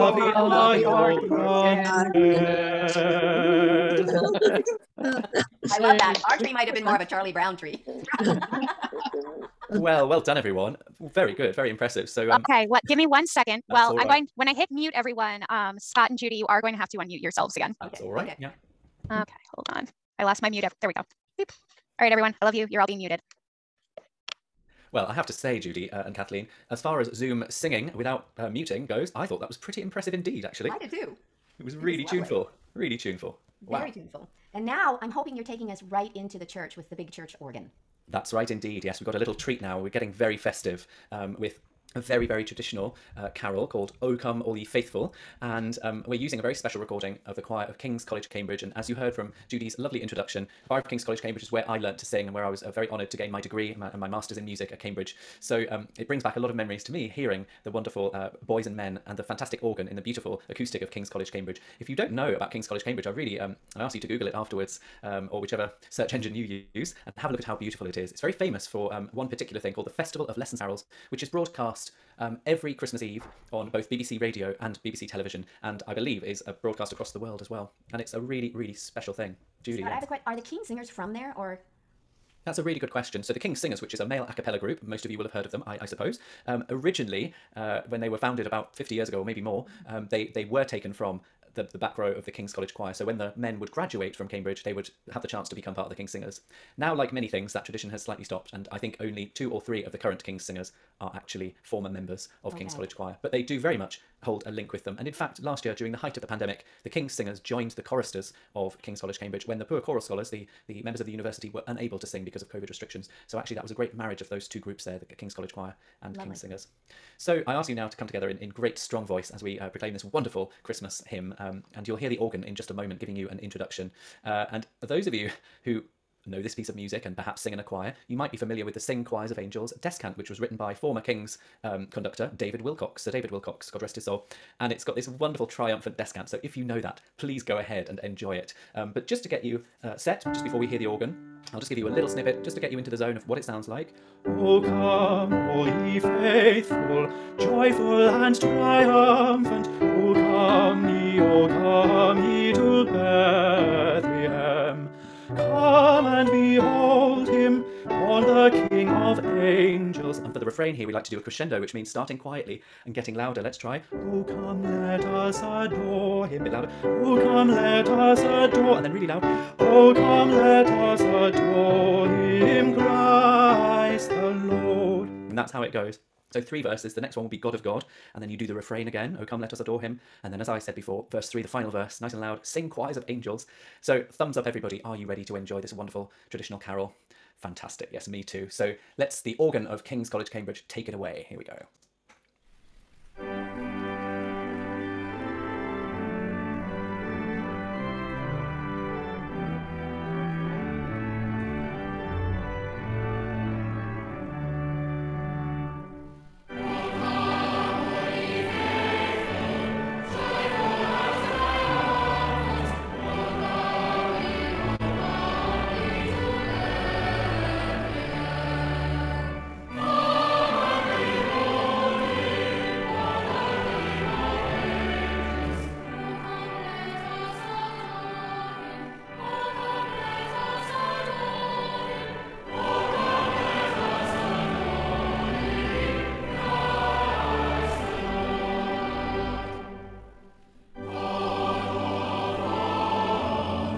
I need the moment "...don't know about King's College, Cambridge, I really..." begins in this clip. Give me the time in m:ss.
1:01.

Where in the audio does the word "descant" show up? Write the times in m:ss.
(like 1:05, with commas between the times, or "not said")
2:09, 2:15.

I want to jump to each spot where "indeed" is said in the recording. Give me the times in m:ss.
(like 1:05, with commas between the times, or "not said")
0:30, 0:38.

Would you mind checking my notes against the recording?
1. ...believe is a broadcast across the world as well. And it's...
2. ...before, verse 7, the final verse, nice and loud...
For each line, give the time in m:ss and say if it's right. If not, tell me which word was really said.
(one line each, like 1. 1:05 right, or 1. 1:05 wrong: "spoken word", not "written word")
1. 1:15 right
2. 3:00 wrong: "3", not "7".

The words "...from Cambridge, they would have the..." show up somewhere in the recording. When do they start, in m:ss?
1:34.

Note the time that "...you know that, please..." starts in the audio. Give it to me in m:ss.
2:16.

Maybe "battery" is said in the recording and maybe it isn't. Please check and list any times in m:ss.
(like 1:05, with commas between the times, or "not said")
not said.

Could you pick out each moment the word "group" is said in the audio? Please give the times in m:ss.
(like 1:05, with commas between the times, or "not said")
1:24, 1:54.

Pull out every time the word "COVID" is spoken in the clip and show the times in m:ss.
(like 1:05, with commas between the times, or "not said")
1:52.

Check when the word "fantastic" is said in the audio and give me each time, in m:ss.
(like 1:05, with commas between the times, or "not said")
0:59, 3:07.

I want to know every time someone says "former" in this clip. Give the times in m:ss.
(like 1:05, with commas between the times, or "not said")
1:41, 2:10.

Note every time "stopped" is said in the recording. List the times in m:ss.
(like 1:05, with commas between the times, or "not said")
1:38.